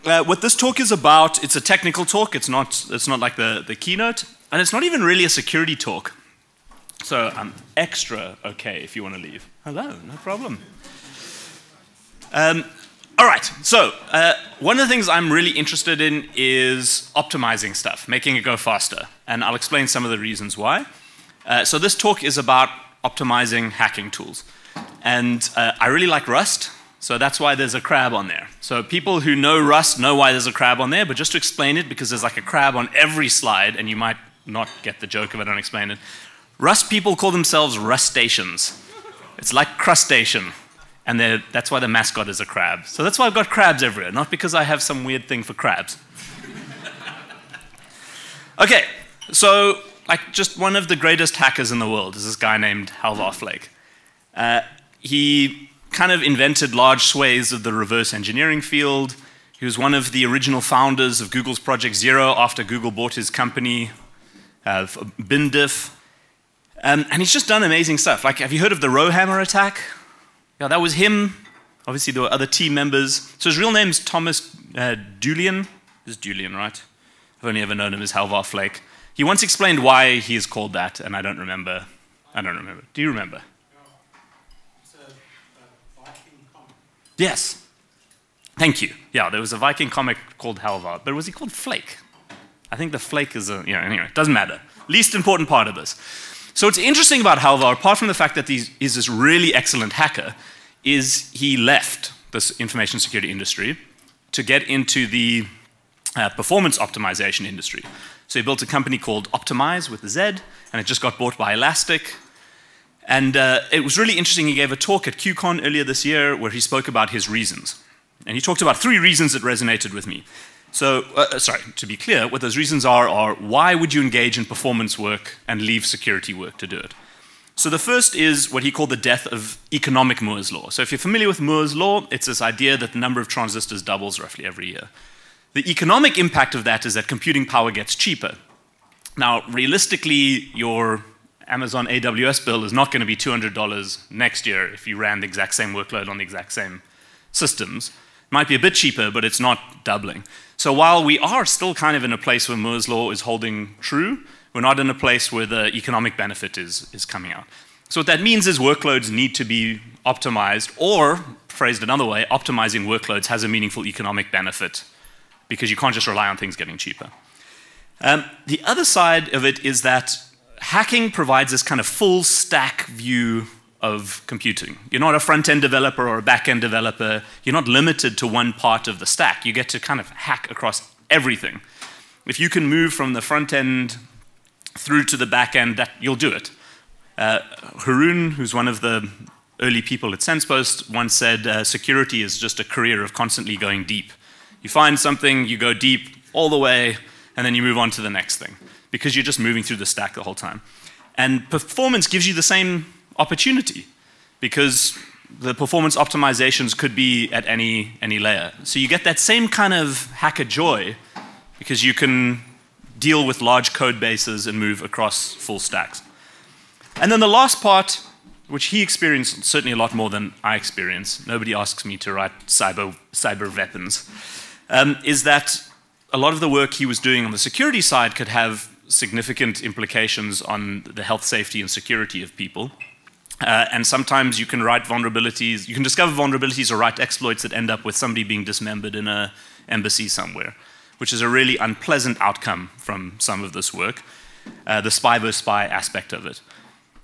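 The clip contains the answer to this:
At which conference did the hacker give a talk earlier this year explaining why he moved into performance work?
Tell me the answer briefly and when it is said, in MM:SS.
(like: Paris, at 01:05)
QCon, at 01:55.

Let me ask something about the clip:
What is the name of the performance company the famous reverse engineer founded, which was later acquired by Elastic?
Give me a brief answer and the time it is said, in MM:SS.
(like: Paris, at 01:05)
Optimize, at 01:49.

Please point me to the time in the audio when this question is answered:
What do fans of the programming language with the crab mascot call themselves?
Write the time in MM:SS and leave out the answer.
00:37.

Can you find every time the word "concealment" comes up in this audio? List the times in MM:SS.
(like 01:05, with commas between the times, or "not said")
not said.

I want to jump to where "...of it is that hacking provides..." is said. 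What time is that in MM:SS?
02:49.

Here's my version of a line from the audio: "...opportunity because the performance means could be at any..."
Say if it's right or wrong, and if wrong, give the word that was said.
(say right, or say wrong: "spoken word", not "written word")
wrong: "optimizations", not "means".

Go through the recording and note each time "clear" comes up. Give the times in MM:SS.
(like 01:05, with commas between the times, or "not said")
02:01.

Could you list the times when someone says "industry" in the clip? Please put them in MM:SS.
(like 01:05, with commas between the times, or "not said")
01:43, 01:47.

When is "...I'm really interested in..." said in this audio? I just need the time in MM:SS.
00:15.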